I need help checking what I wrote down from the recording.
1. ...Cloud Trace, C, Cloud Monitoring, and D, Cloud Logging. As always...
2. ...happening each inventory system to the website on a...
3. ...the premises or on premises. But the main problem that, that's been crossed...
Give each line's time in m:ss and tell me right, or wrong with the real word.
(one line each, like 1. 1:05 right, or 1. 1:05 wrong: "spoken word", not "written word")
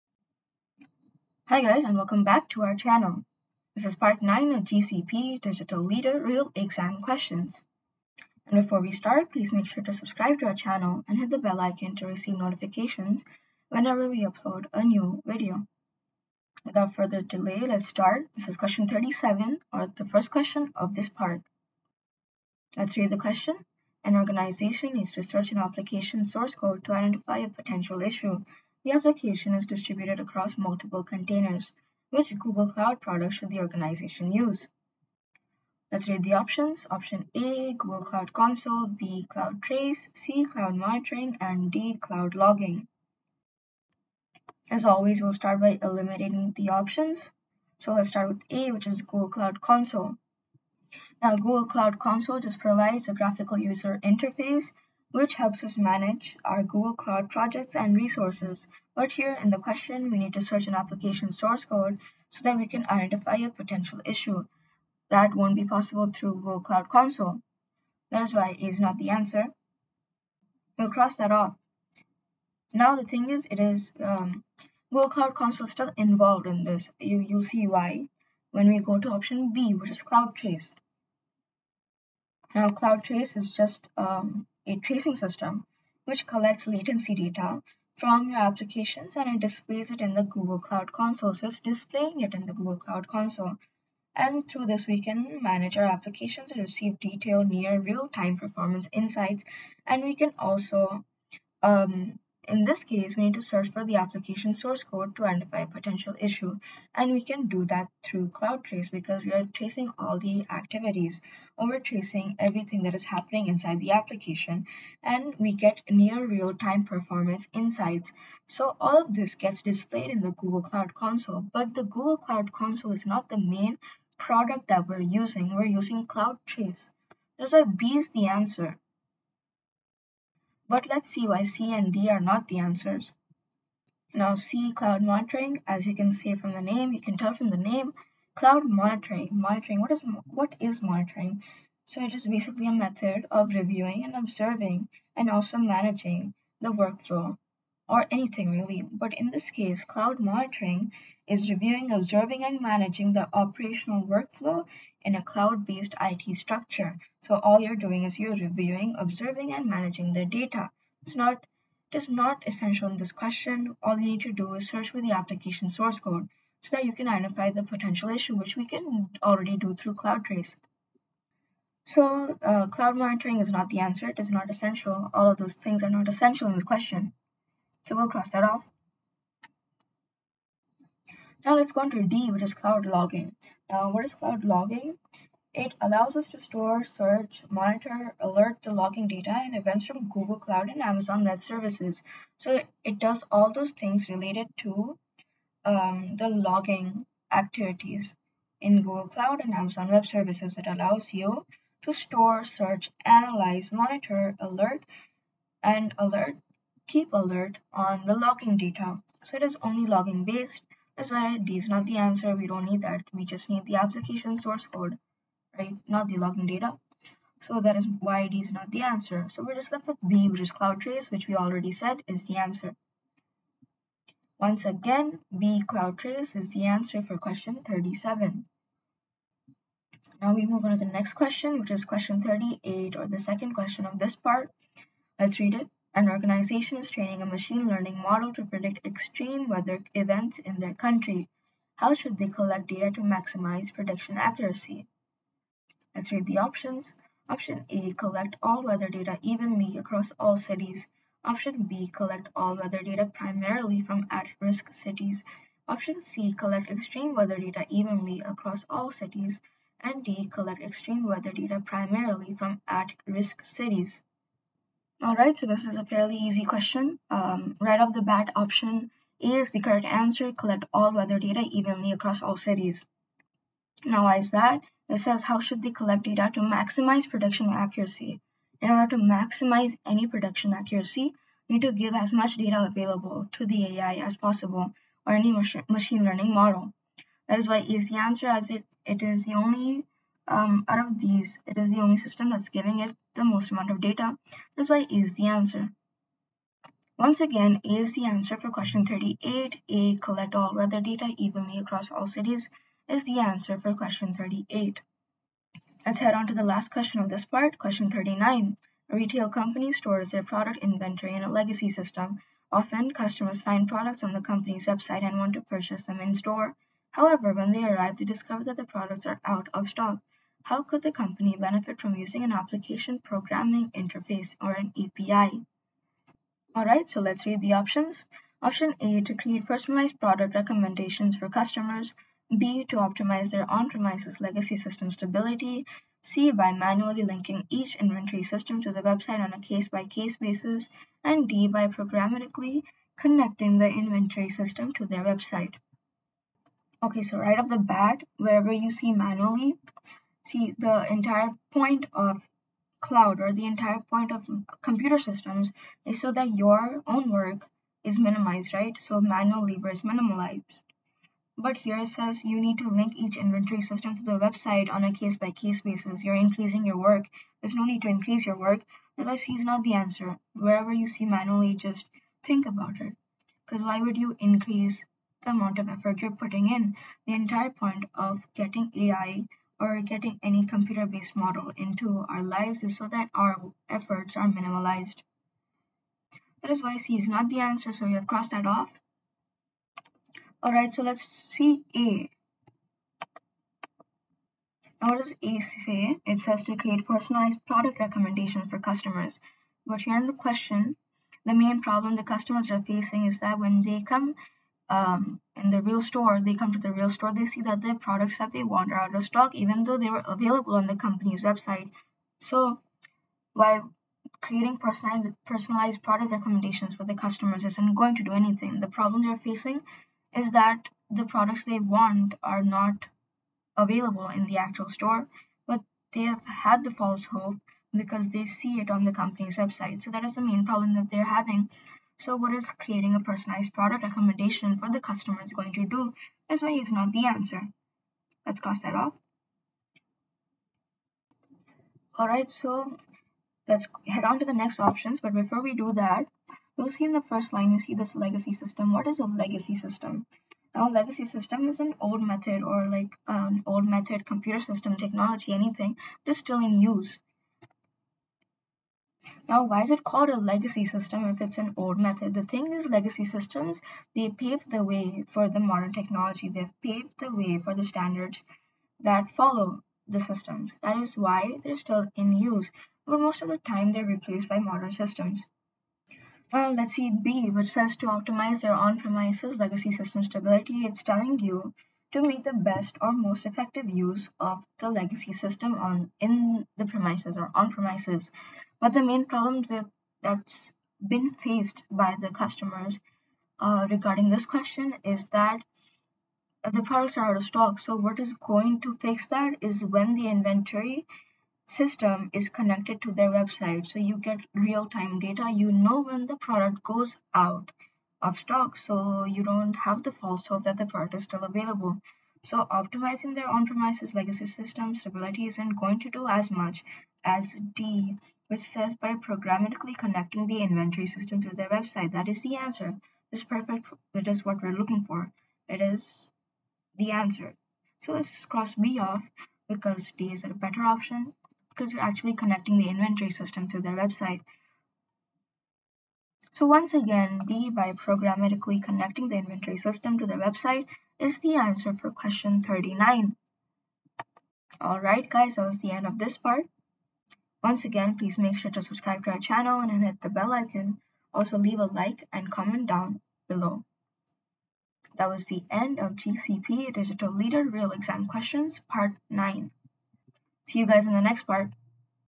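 1. 0:39 right
2. 5:37 wrong: "linking", not "happening"
3. 8:06 wrong: "faced", not "crossed".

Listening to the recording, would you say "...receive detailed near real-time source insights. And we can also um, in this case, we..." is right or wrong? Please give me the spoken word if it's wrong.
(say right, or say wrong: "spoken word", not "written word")
wrong: "performance", not "source".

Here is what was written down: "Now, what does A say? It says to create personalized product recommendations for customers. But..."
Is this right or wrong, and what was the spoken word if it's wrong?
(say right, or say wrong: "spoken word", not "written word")
right.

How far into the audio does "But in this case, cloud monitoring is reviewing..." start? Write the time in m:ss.
2:28.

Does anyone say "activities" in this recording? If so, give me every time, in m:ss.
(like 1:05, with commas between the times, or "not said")
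1:50, 3:17.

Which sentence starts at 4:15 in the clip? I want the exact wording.
Option C collect extreme weather data evenly across all cities.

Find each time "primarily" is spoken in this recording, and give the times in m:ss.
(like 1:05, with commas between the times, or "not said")
4:13, 4:21.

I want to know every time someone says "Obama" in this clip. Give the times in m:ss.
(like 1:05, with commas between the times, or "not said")
not said.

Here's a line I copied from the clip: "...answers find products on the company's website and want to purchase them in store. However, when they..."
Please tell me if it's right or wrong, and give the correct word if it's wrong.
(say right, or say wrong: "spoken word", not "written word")
wrong: "customers", not "answers".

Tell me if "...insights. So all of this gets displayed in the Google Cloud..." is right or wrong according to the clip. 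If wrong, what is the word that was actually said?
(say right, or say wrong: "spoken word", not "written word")
right.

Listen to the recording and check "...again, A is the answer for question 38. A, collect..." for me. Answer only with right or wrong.
right.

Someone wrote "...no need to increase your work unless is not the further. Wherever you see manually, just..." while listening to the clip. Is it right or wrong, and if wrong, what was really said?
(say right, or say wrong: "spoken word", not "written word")
wrong: "answer", not "further".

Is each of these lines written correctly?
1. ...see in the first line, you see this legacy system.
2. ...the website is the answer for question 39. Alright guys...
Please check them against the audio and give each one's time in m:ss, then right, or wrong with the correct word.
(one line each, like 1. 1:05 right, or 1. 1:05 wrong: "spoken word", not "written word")
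1. 7:26 right
2. 9:00 right.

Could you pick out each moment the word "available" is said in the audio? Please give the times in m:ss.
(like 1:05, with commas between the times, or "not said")
4:42, 6:50, 7:03, 8:31.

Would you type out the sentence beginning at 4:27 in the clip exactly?
Um, right off the bat, option A is the correct answer.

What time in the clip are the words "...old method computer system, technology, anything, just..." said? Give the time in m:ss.
7:33.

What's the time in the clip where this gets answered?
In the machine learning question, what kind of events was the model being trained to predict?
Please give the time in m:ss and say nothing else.
3:58.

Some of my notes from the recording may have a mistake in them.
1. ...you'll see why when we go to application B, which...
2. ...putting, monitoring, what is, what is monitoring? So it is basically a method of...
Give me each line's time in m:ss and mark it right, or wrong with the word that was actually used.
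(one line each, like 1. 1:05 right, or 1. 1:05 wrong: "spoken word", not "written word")
1. 1:17 wrong: "option", not "application"
2. 2:18 wrong: "monitoring", not "putting".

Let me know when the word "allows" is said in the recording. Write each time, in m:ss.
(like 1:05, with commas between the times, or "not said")
3:05, 3:20.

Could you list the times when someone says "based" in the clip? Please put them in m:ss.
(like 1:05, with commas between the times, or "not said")
2:35, 3:30, 6:20.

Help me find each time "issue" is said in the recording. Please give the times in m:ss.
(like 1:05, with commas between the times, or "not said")
0:28, 1:04, 1:46, 2:48.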